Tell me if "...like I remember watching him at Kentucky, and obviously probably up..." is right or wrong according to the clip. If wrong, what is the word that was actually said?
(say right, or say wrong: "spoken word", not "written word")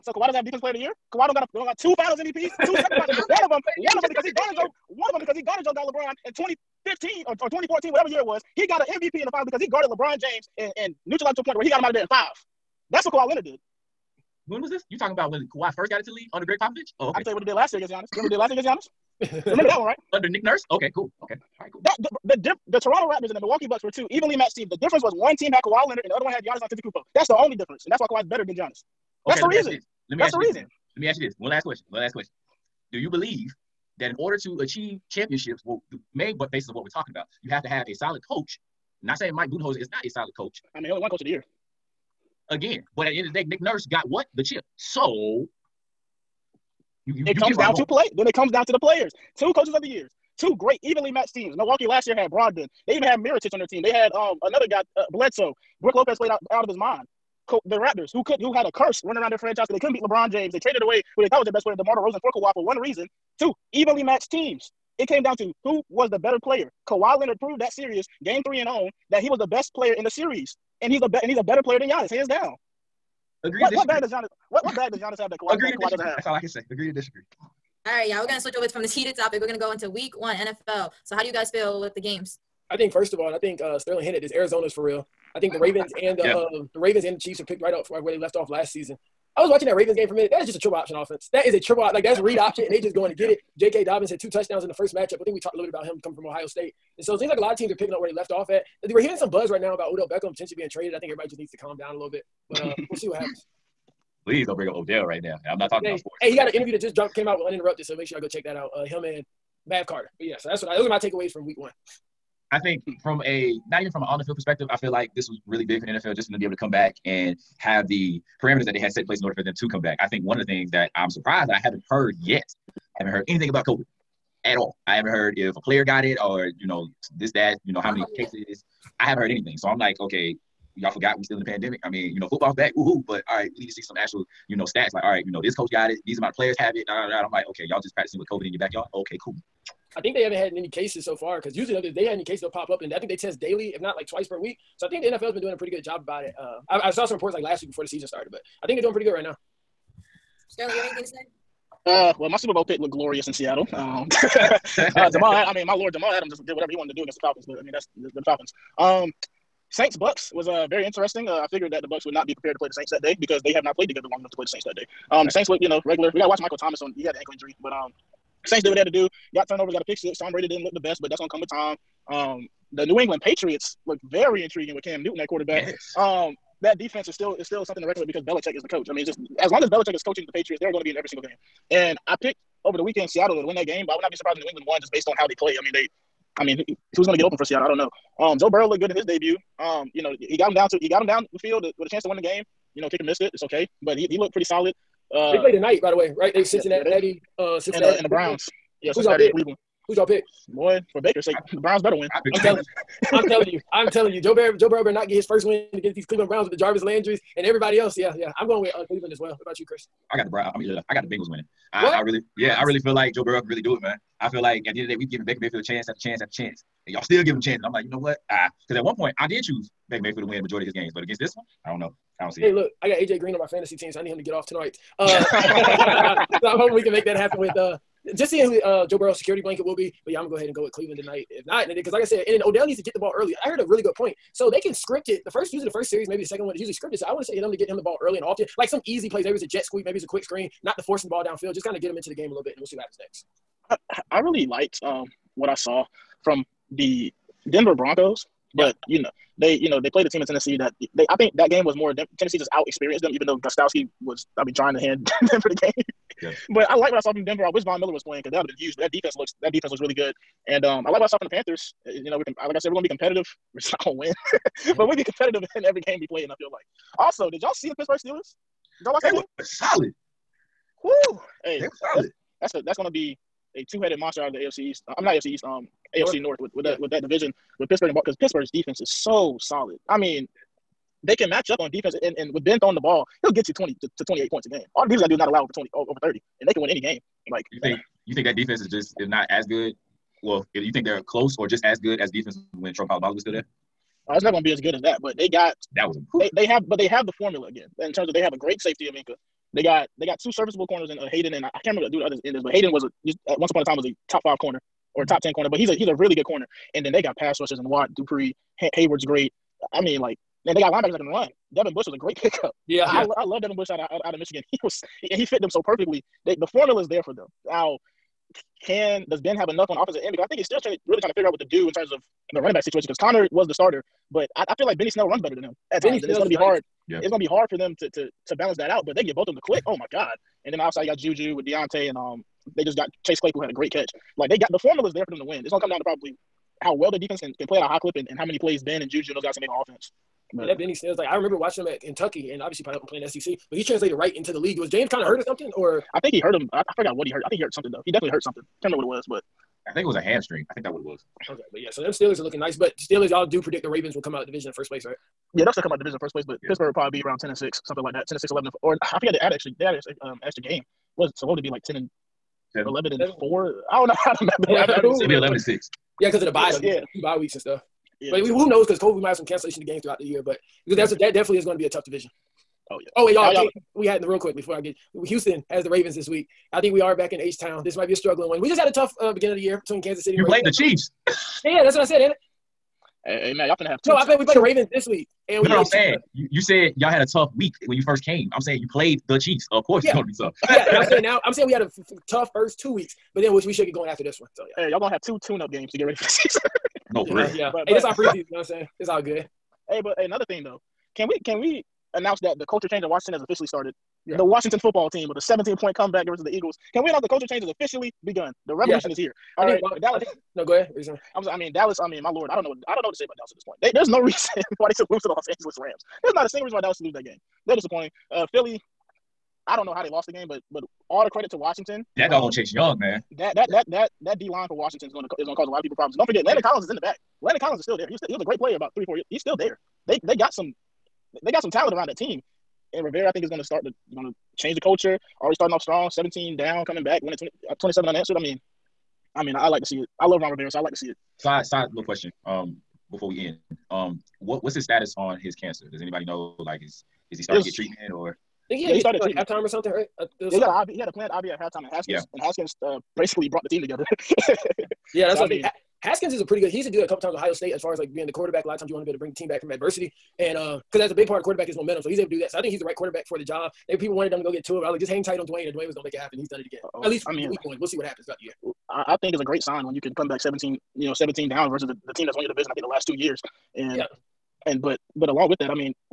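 right.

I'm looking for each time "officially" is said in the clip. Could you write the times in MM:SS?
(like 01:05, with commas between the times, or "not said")
06:43, 06:47.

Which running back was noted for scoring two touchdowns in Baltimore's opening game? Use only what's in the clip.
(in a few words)
J.K. Dobbins.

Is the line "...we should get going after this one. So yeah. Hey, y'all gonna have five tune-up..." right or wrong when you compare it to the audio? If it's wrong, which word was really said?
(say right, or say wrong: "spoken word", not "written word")
wrong: "two", not "five".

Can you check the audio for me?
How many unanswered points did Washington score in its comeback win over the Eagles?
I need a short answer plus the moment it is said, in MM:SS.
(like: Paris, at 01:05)
27, at 07:17.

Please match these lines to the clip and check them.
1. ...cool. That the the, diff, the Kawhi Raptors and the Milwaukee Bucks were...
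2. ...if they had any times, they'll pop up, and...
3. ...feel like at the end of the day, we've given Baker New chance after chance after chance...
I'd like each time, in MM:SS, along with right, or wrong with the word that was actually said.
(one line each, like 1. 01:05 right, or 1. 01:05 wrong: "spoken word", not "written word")
1. 00:21 wrong: "Toronto", not "Kawhi"
2. 02:21 wrong: "cases", not "times"
3. 03:34 wrong: "Mayfield", not "New".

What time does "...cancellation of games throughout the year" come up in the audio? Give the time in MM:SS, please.
06:09.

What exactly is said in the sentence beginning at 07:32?
and Haskins uh, basically brought the team together.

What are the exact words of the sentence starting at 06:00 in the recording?
Was so what would it be like ten and Seven.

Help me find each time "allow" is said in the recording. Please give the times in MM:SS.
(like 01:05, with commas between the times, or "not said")
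04:45.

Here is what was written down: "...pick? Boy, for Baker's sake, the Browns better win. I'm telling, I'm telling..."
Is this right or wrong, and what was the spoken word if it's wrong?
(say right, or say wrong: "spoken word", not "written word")
right.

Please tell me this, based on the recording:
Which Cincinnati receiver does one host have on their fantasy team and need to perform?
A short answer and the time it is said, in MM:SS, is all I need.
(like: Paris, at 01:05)
AJ Green, at 03:42.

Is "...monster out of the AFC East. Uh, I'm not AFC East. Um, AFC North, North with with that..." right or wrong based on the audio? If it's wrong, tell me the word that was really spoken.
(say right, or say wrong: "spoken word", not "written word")
right.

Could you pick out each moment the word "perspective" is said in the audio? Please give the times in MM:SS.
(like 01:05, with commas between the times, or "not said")
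01:54.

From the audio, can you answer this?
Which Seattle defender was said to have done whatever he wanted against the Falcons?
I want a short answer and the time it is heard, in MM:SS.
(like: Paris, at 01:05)
Jamal Adams, at 02:35.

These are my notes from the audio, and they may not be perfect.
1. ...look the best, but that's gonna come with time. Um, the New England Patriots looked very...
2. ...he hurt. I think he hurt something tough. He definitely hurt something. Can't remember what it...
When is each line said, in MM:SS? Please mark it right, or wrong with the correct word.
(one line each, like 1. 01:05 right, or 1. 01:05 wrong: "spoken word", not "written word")
1. 02:50 right
2. 05:47 wrong: "though", not "tough".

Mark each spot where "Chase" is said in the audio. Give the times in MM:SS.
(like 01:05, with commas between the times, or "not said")
05:33, 07:02.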